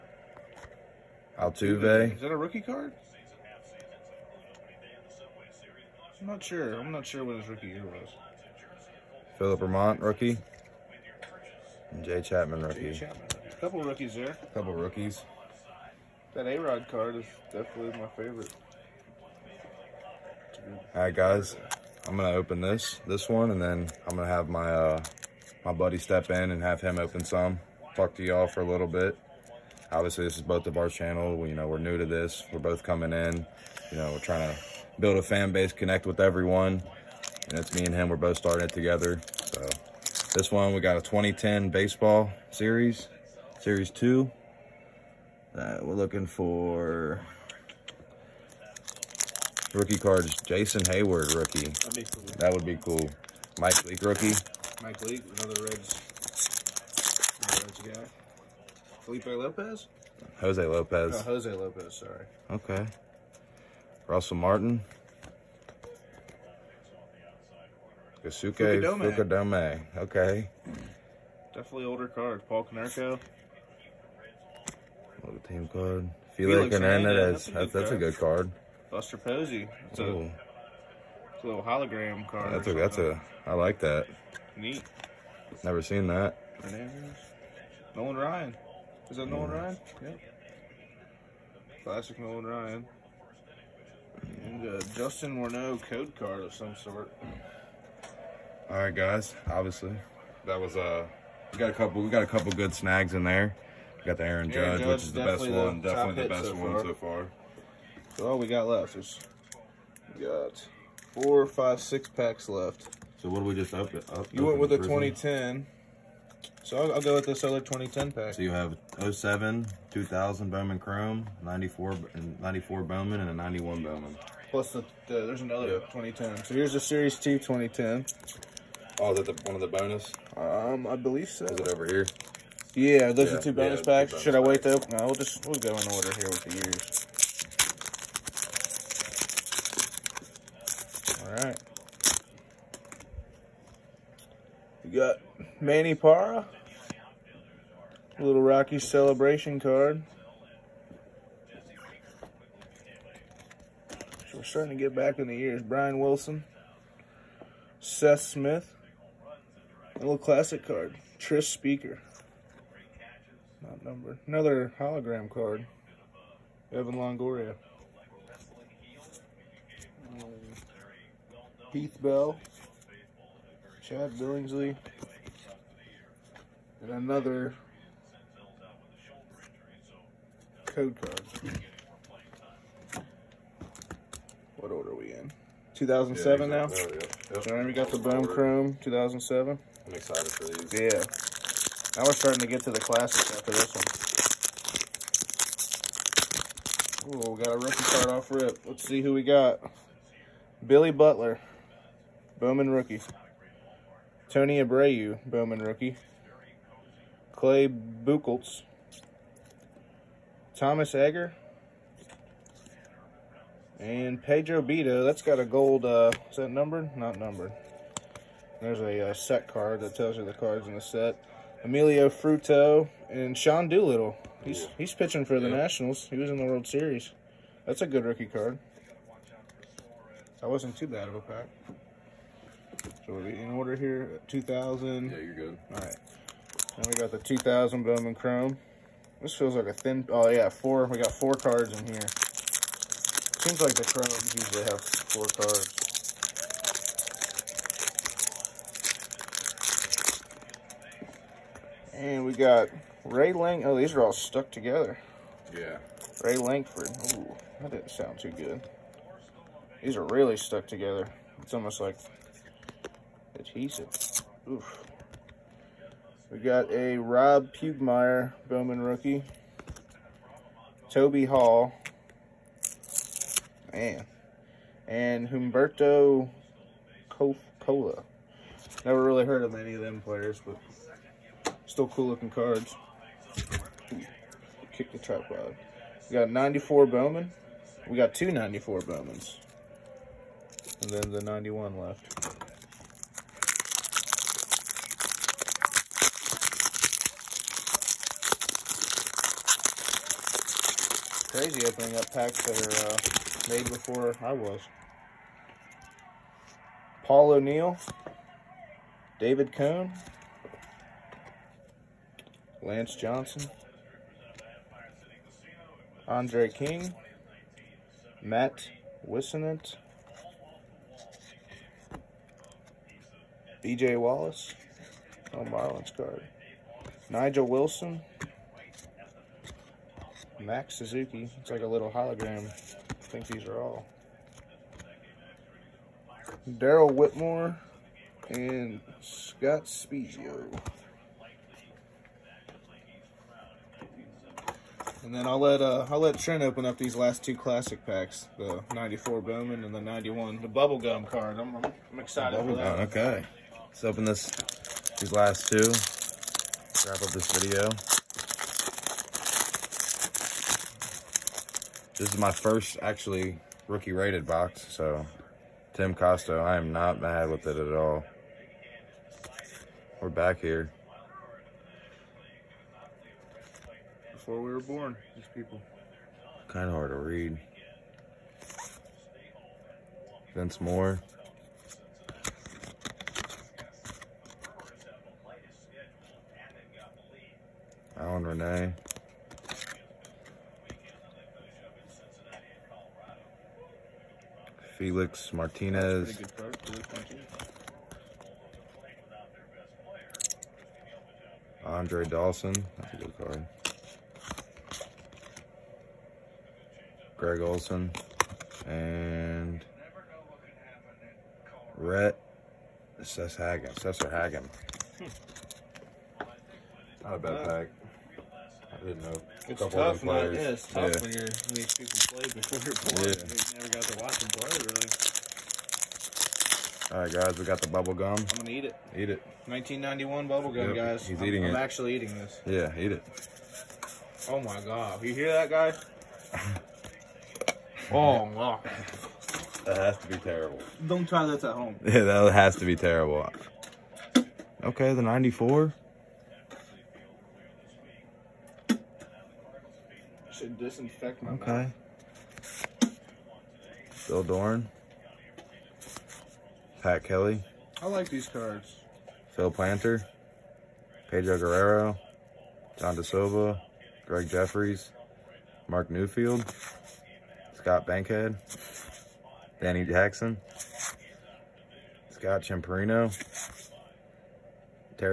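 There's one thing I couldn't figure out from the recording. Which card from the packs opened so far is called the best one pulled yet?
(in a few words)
Aaron Judge.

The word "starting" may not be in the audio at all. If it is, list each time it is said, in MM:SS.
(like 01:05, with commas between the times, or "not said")
00:38, 02:34, 03:12.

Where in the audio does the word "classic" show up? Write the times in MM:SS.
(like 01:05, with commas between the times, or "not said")
01:31, 02:40, 03:12, 05:47.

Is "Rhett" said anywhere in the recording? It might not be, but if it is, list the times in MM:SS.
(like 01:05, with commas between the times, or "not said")
06:51.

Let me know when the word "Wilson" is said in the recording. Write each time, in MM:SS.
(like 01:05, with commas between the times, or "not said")
02:35, 05:27.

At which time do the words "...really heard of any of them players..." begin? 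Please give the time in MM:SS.
04:39.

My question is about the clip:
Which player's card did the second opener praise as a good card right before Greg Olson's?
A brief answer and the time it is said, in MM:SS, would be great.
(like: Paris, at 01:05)
Andre Dawson, at 06:41.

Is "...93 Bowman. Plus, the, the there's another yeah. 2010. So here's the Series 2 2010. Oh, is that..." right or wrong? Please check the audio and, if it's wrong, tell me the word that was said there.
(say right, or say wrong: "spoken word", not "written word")
wrong: "91", not "93".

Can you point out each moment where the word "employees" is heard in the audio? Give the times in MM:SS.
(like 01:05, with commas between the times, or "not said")
not said.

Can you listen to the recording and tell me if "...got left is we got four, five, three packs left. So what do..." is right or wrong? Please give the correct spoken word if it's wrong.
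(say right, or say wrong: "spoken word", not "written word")
wrong: "six", not "three".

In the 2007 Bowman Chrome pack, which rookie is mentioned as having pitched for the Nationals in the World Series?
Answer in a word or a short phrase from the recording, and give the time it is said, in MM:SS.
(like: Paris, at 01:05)
Sean Doolittle, at 03:43.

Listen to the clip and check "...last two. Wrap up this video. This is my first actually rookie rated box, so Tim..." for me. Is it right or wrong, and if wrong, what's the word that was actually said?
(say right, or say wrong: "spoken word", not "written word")
right.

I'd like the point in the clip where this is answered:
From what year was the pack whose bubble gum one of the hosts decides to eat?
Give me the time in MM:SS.
07:09.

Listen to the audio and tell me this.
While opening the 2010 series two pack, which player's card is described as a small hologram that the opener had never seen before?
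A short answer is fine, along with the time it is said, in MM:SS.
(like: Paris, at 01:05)
Buster Posey, at 01:18.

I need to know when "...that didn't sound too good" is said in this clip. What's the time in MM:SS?
04:17.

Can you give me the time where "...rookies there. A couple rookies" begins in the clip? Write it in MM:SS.
00:13.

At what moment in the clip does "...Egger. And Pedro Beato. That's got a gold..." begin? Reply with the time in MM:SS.
03:30.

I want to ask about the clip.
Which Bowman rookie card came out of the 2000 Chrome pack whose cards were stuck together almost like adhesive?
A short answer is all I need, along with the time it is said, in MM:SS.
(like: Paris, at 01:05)
Rob Pugmire, at 04:26.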